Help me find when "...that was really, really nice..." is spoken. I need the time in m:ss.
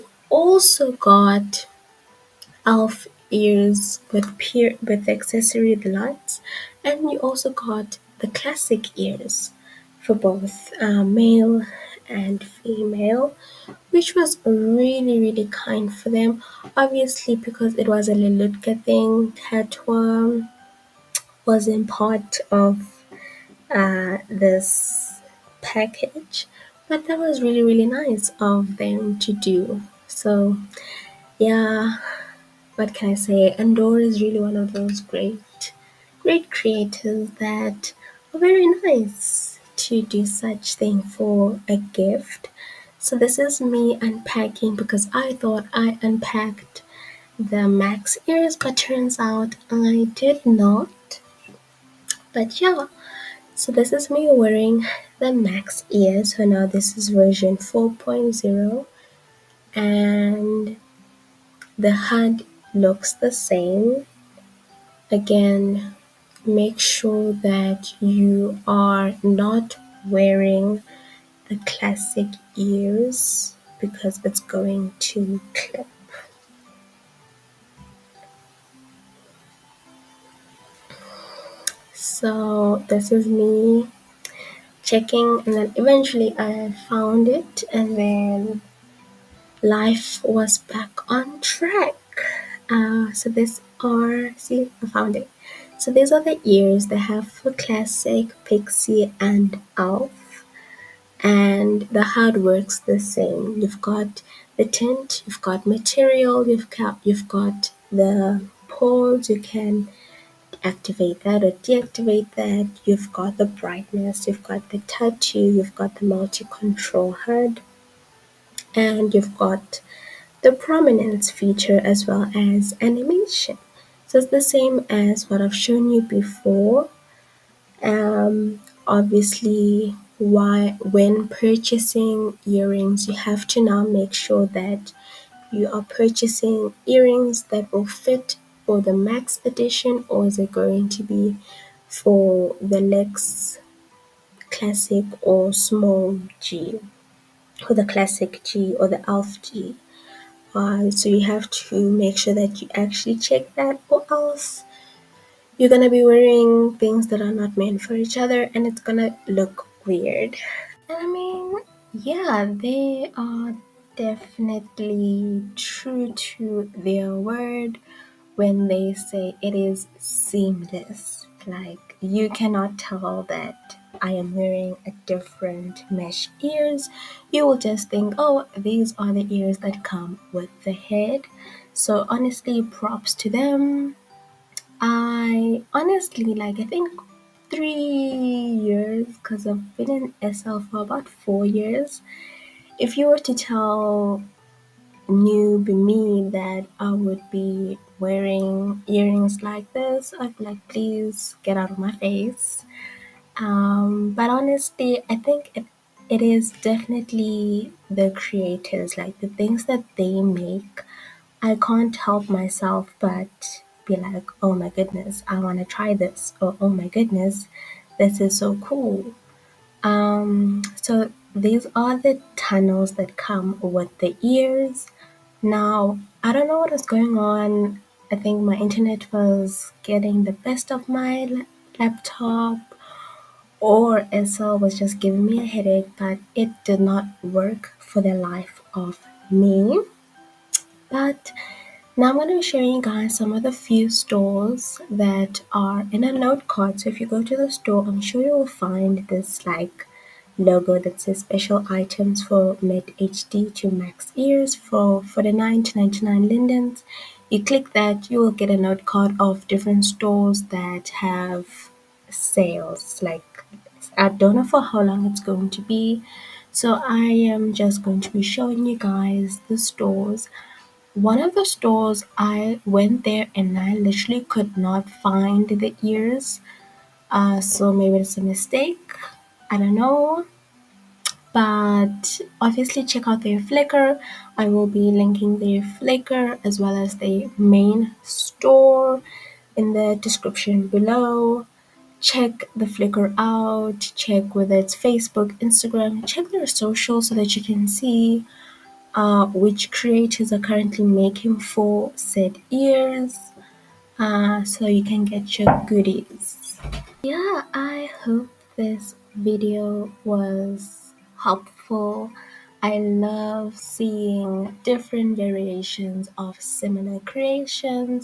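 0:27.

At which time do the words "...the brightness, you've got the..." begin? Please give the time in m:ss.
1:53.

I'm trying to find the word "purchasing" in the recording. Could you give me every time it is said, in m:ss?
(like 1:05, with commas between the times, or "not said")
2:11, 2:15.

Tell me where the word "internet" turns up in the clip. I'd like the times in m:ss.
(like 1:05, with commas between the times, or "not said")
3:48.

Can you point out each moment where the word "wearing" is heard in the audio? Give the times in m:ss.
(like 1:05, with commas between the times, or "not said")
0:54, 1:10, 2:36, 2:54, 3:17.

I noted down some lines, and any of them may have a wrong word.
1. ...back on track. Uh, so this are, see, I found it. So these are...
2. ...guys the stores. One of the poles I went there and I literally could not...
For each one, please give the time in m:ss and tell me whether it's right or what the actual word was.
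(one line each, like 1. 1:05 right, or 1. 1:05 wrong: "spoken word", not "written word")
1. 1:30 right
2. 4:28 wrong: "stores", not "poles".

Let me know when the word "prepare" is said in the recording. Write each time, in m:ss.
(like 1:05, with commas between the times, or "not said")
not said.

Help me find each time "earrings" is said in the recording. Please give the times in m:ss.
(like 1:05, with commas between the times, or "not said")
2:12, 2:16, 3:18.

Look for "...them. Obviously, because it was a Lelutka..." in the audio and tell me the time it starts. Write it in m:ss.
0:16.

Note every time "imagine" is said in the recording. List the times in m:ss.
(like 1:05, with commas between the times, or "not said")
not said.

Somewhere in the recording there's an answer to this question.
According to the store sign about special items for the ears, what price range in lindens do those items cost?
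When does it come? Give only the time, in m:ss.
4:15.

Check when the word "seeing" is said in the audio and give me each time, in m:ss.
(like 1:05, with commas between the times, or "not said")
5:13.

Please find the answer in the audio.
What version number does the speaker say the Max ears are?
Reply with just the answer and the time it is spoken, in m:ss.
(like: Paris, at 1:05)
4.0, at 0:57.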